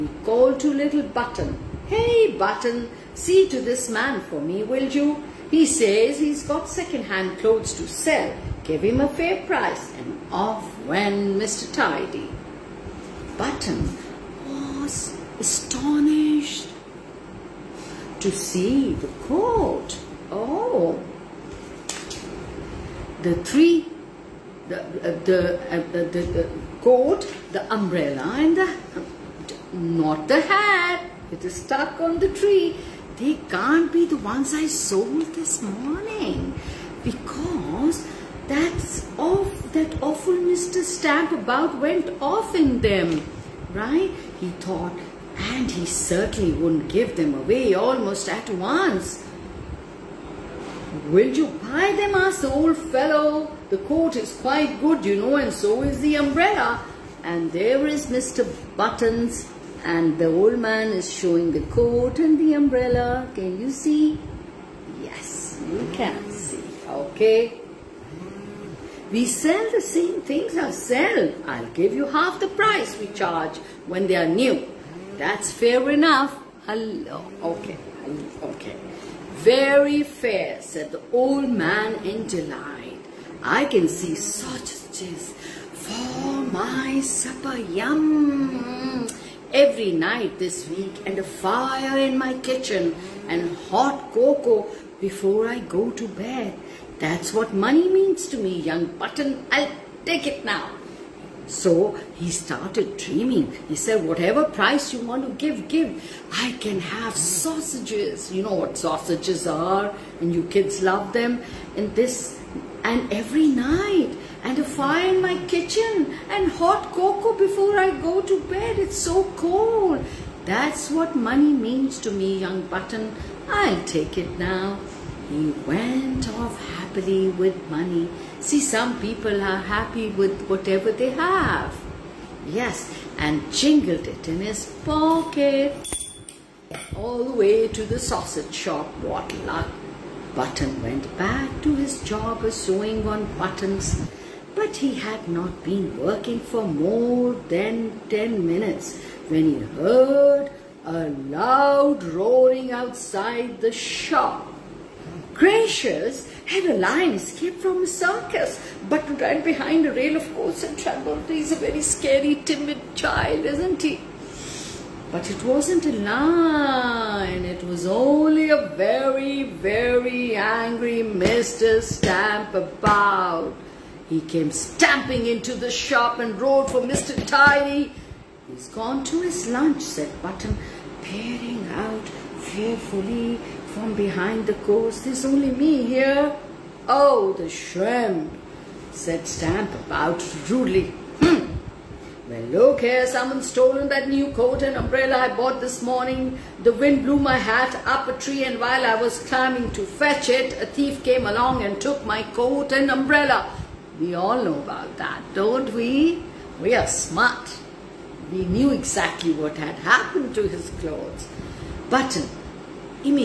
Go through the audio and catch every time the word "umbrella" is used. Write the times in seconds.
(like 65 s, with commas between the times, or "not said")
27 s, 56 s, 62 s, 194 s, 202 s.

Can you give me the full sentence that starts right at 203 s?
We all know about that, don't we?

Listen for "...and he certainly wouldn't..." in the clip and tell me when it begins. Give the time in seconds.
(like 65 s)
45 s.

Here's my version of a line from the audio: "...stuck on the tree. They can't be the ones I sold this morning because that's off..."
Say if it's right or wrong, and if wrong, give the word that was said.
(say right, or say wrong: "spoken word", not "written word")
right.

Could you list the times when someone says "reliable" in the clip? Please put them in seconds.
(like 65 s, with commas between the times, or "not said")
not said.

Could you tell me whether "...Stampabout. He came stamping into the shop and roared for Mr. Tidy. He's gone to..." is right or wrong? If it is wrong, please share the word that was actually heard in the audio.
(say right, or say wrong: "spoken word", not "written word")
right.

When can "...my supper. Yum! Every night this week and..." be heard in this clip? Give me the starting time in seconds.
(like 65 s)
86 s.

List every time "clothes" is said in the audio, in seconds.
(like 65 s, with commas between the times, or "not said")
7 s, 210 s.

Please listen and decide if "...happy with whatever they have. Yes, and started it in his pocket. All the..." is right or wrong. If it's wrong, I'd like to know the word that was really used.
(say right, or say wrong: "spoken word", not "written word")
wrong: "jingled", not "started".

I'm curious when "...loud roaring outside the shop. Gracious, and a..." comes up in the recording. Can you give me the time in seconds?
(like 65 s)
151 s.